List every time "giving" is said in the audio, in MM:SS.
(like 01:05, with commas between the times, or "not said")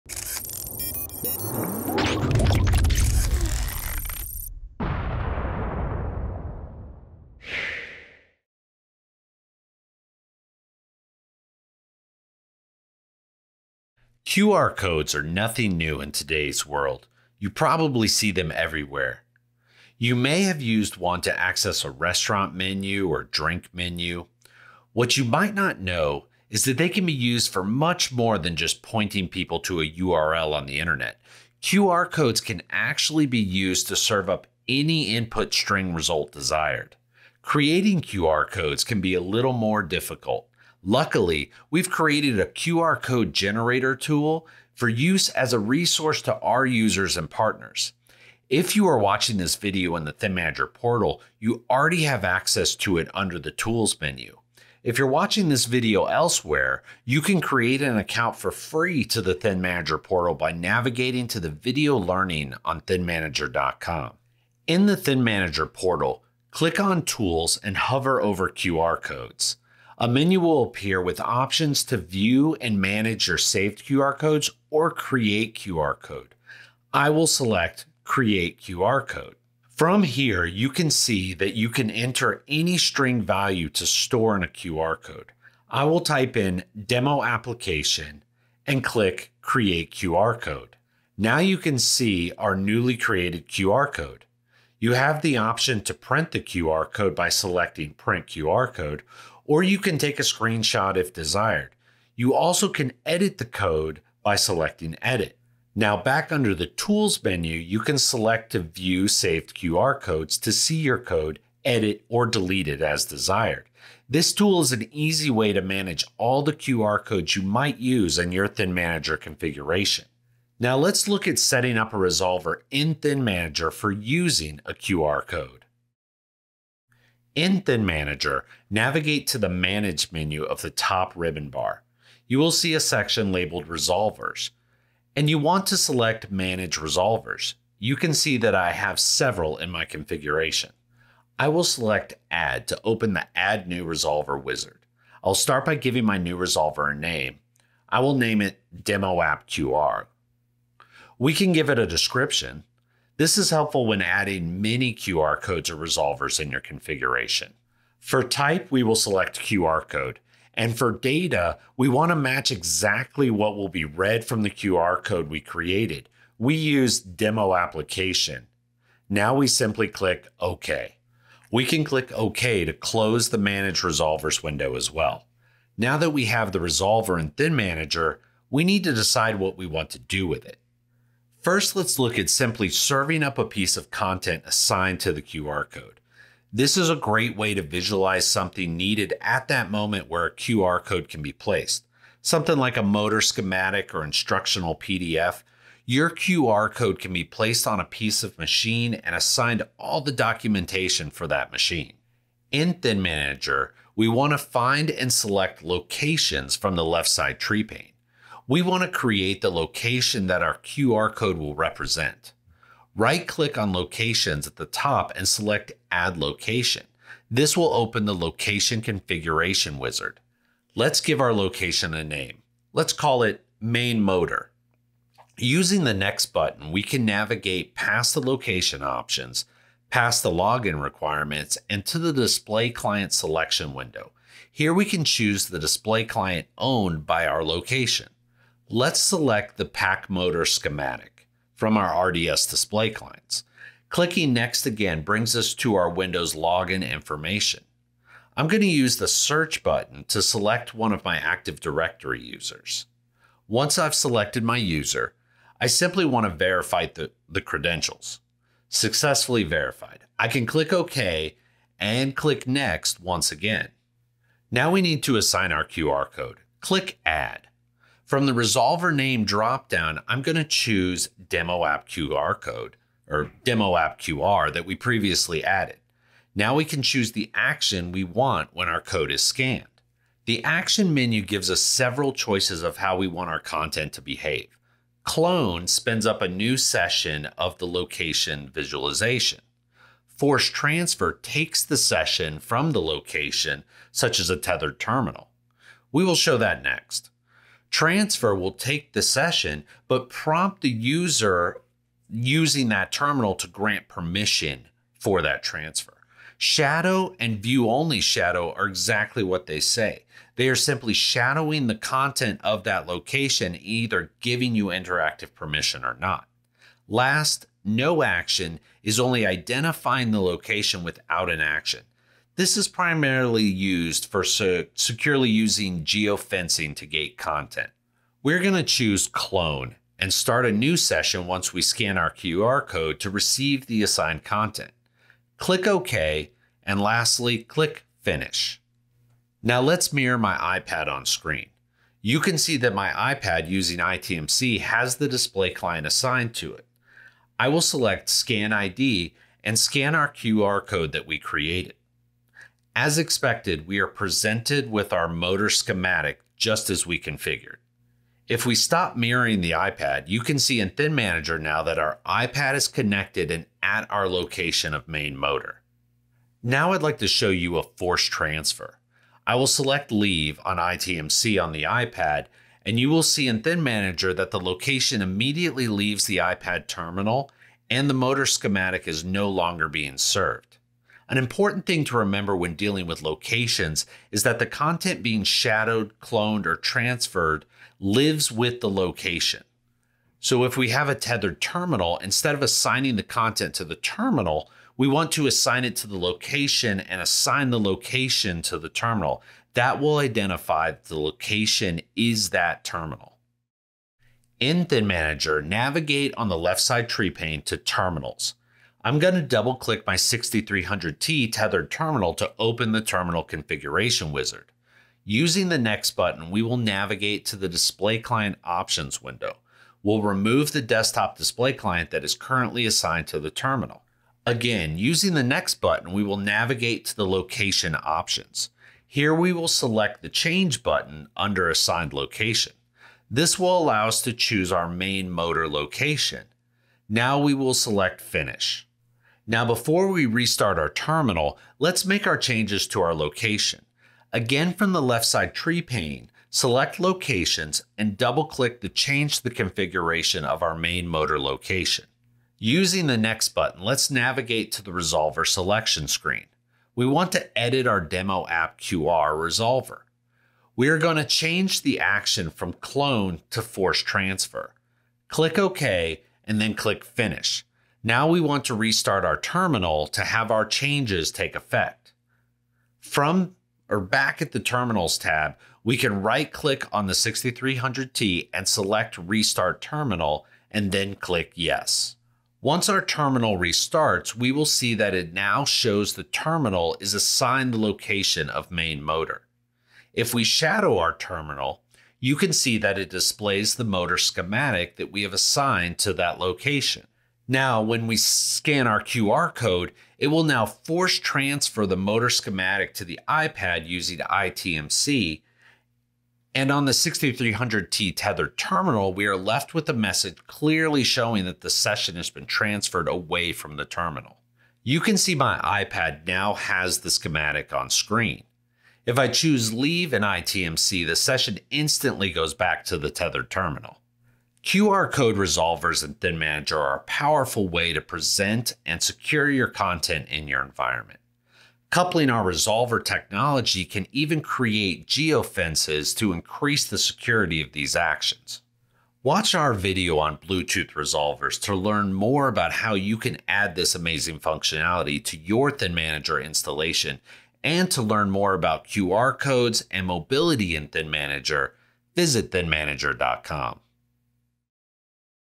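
02:25, 05:14.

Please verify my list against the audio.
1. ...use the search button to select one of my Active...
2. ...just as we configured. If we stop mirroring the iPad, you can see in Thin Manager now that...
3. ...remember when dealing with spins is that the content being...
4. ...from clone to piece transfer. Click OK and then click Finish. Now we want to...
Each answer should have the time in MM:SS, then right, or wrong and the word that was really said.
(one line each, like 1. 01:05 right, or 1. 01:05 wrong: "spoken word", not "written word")
1. 04:08 right
2. 05:56 right
3. 06:21 wrong: "locations", not "spins"
4. 07:42 wrong: "force", not "piece".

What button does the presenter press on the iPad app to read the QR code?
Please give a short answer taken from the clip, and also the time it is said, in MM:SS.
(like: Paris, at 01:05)
Scan ID, at 05:48.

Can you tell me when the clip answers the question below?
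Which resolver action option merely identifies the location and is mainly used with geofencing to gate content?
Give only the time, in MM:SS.
05:17.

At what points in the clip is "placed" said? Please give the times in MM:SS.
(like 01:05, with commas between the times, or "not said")
03:11, 03:17.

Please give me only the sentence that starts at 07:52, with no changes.
From or back at the Terminals tab, we can right click on the 6300T and select Restart Terminal and then click Yes.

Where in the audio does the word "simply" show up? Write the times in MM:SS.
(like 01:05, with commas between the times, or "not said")
02:49, 03:02, 04:15, 05:10.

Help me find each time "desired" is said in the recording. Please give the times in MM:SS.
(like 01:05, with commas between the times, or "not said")
00:36, 01:41, 01:53.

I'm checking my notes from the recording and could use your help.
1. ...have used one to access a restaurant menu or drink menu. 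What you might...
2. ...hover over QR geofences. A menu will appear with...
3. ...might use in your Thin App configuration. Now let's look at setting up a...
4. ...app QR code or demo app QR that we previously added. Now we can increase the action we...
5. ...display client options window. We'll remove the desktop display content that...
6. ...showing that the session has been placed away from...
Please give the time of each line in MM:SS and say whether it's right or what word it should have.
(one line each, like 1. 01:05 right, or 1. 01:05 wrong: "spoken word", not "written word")
1. 00:20 right
2. 01:07 wrong: "codes", not "geofences"
3. 01:57 wrong: "Manager", not "App"
4. 04:31 wrong: "choose", not "increase"
5. 06:57 wrong: "client", not "content"
6. 08:30 wrong: "transferred", not "placed".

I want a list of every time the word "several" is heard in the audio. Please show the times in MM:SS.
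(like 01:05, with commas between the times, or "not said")
02:18, 04:41.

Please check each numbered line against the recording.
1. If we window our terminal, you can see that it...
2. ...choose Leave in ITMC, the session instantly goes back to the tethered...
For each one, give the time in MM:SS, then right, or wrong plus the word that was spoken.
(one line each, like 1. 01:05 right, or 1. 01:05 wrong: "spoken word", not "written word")
1. 08:09 wrong: "shadow", not "window"
2. 08:39 right.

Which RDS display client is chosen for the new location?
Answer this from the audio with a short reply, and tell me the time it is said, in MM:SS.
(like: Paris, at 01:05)
pack motor schematic, at 03:59.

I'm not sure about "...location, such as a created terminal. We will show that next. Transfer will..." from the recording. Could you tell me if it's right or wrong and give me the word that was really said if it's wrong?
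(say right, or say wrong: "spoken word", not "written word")
wrong: "tethered", not "created".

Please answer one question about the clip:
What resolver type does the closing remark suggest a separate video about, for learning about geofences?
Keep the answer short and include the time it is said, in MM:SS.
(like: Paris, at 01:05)
Bluetooth resolvers, at 09:00.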